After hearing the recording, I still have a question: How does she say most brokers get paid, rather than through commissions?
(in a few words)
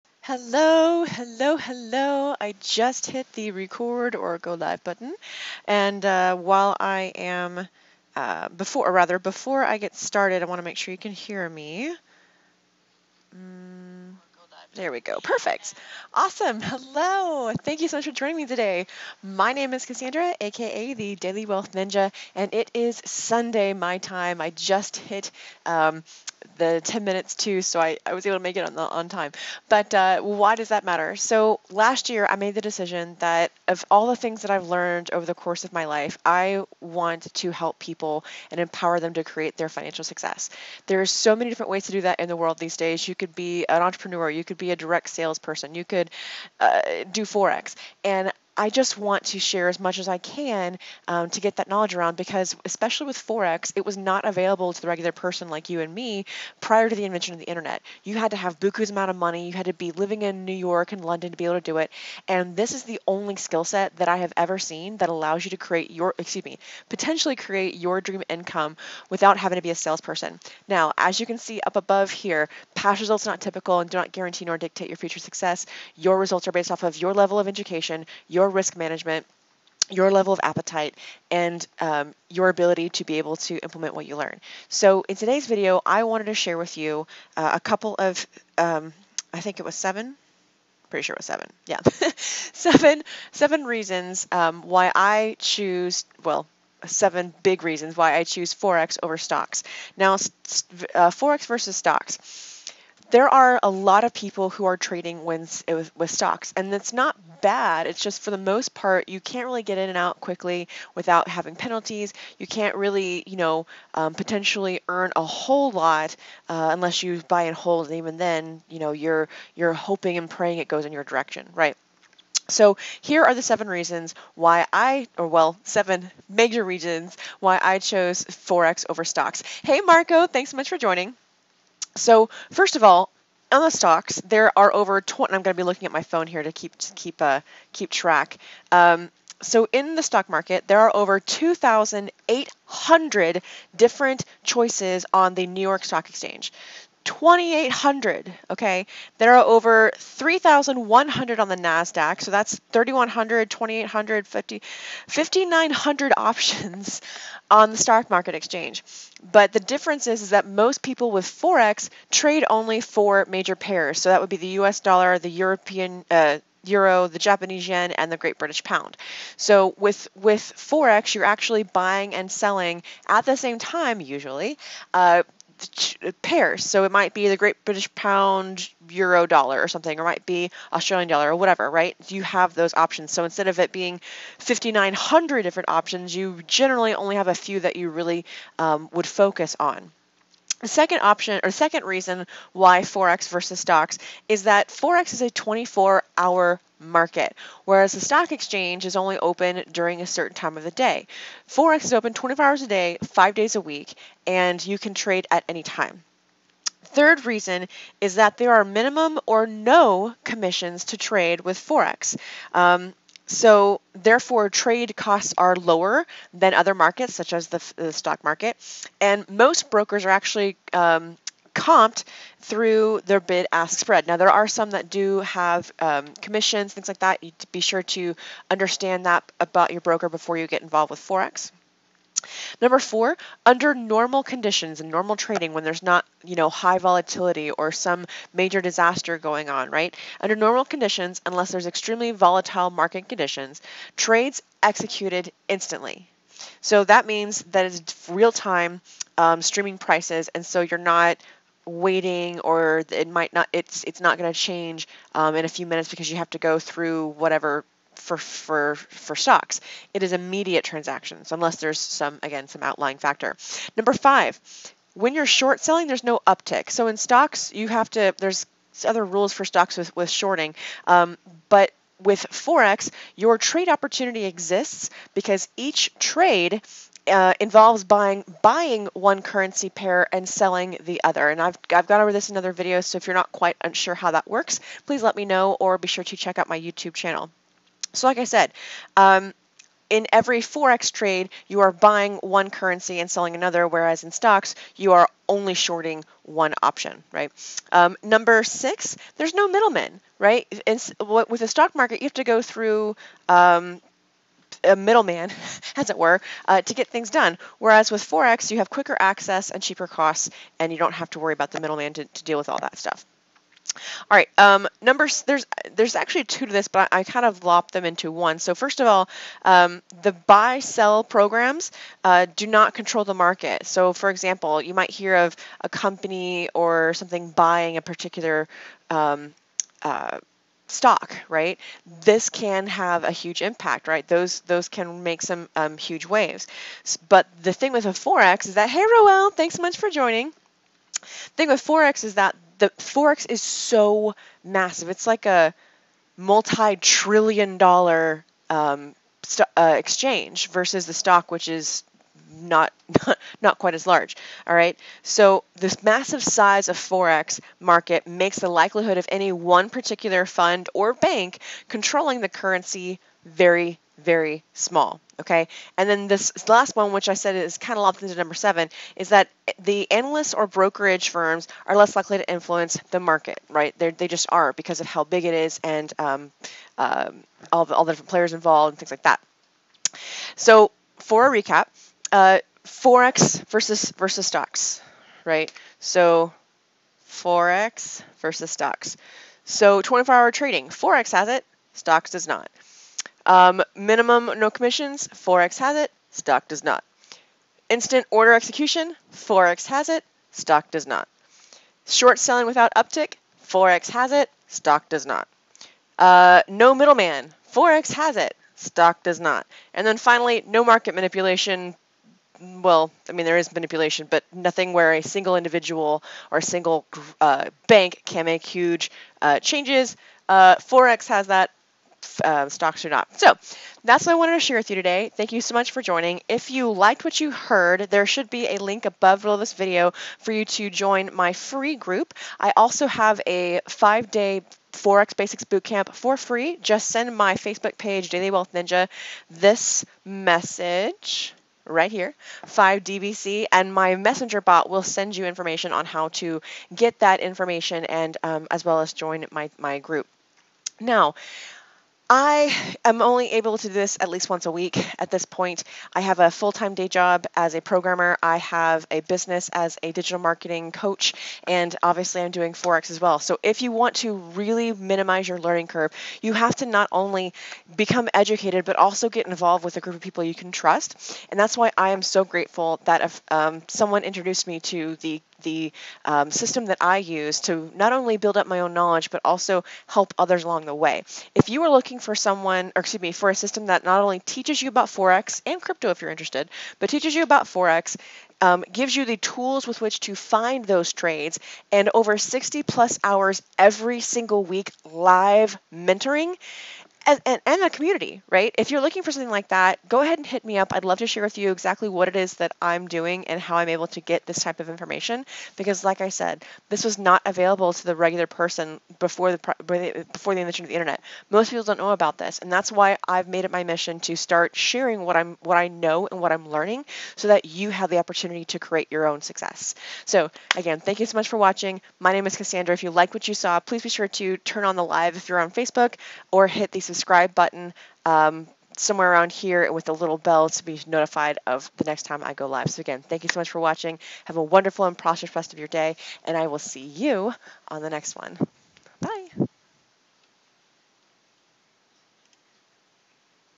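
bid ask spread.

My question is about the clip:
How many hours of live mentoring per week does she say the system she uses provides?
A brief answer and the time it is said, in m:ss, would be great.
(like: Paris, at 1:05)
over 60, at 8:12.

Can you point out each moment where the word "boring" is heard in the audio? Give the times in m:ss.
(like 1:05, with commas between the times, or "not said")
not said.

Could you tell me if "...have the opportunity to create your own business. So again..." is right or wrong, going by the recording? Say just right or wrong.
wrong.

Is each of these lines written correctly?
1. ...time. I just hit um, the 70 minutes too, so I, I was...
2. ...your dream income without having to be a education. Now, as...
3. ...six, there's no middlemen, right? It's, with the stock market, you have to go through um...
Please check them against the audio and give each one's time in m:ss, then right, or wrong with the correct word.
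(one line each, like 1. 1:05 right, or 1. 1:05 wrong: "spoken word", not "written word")
1. 0:23 wrong: "10", not "70"
2. 1:07 wrong: "salesperson", not "education"
3. 4:58 right.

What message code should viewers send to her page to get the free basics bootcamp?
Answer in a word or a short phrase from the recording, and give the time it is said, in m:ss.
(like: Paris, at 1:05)
5DBC, at 7:22.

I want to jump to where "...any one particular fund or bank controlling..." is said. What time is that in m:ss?
5:59.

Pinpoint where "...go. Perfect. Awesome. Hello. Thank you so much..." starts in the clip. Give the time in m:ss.
0:15.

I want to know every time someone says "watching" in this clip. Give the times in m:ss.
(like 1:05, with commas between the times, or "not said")
8:41, 8:53.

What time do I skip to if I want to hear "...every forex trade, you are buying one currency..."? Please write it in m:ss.
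4:50.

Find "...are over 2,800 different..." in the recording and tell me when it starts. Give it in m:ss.
2:20.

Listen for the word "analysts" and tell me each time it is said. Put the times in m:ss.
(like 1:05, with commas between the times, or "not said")
6:09.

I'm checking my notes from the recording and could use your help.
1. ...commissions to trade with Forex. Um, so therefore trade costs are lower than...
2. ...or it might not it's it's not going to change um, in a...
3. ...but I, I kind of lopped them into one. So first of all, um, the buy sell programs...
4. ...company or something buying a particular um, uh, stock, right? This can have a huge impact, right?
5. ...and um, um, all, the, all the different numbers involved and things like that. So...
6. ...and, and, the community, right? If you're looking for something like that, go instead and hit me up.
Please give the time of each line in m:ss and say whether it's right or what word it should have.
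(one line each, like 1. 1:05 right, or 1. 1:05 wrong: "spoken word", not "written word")
1. 3:30 right
2. 4:12 right
3. 5:16 right
4. 5:25 right
5. 6:15 wrong: "players", not "numbers"
6. 8:17 wrong: "ahead", not "instead".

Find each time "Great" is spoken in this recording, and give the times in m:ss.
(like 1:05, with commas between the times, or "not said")
2:48, 2:57.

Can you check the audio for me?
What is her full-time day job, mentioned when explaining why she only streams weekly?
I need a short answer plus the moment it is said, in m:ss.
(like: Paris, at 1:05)
programmer, at 7:37.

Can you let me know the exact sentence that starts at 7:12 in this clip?
I also have a five-day Forex Basics Bootcamp for free.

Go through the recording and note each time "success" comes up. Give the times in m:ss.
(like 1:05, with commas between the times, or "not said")
0:40, 1:15, 8:39.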